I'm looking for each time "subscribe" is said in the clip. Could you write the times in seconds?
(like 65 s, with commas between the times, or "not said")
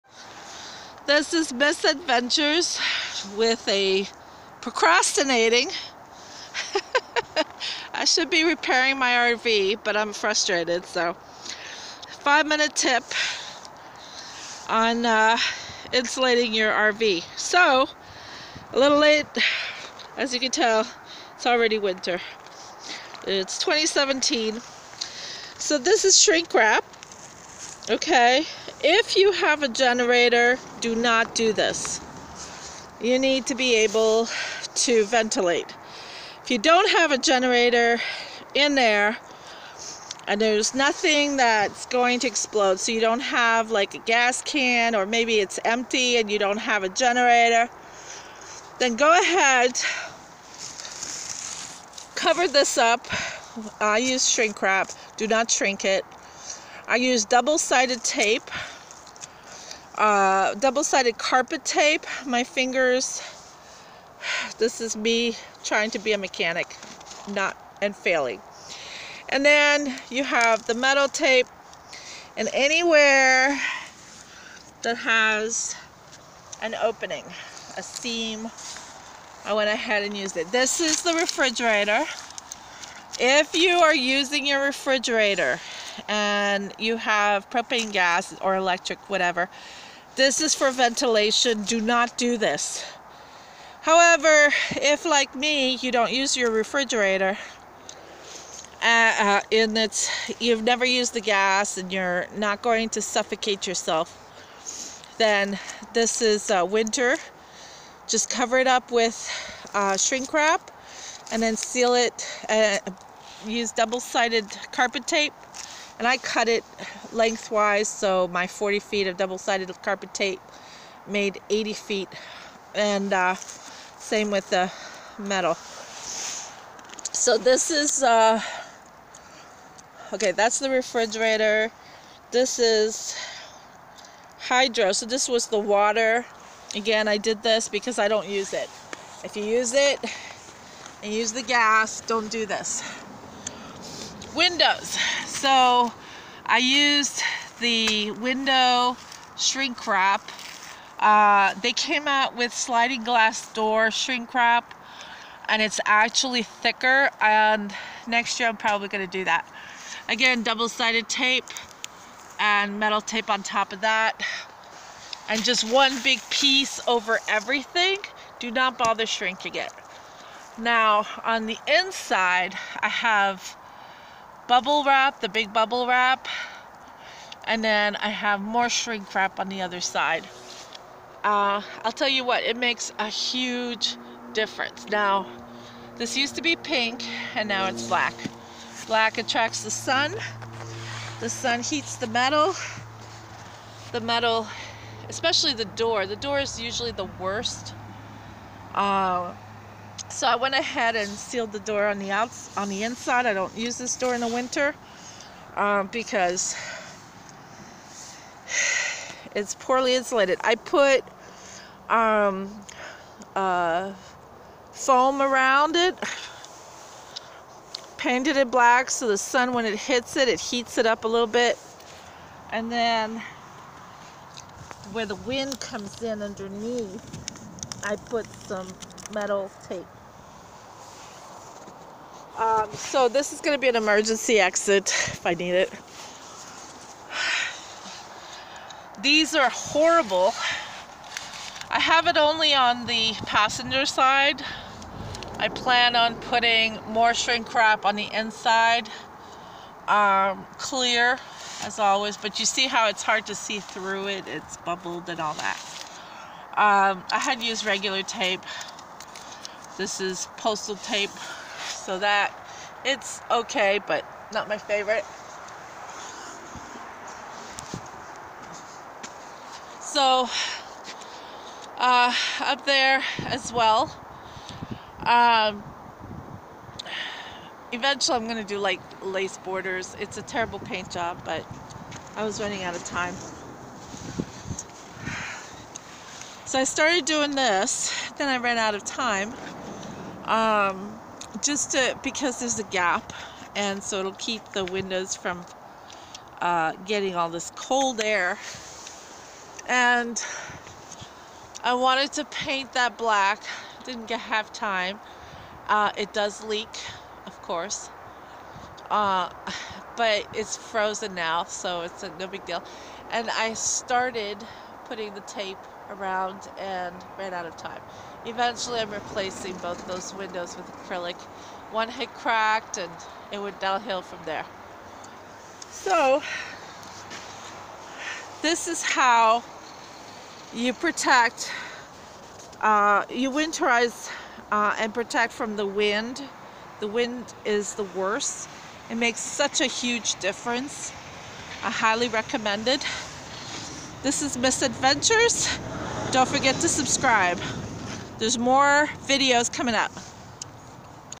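346 s.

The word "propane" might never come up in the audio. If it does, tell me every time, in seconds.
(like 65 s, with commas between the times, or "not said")
87 s.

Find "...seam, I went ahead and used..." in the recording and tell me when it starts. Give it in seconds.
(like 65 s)
77 s.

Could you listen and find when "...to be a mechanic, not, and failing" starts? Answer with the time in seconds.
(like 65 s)
65 s.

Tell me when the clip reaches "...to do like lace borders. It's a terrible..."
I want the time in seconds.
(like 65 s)
278 s.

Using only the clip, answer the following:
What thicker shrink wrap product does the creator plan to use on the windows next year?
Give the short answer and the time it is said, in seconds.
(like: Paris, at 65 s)
Sliding glass door shrink wrap, at 152 s.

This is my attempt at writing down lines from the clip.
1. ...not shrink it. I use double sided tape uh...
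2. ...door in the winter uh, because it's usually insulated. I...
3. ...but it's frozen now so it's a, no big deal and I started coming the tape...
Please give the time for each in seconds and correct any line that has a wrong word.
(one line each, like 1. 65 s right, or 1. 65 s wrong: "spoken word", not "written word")
1. 55 s right
2. 203 s wrong: "poorly", not "usually"
3. 309 s wrong: "putting", not "coming".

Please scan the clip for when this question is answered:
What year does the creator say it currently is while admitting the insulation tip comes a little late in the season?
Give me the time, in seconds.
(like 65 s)
23 s.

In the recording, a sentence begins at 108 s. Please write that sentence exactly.
Just cover it up with uh, shrink wrap and then seal it.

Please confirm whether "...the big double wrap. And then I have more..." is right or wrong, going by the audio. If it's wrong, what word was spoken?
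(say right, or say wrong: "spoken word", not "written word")
wrong: "bubble", not "double".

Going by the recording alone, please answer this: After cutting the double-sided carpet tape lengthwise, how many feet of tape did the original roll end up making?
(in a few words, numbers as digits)
80 feet.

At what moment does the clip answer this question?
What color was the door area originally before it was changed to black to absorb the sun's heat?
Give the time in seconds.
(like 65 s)
186 s.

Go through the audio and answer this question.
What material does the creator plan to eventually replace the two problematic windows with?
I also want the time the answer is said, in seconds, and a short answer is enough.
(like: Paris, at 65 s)
Acrylic, at 320 s.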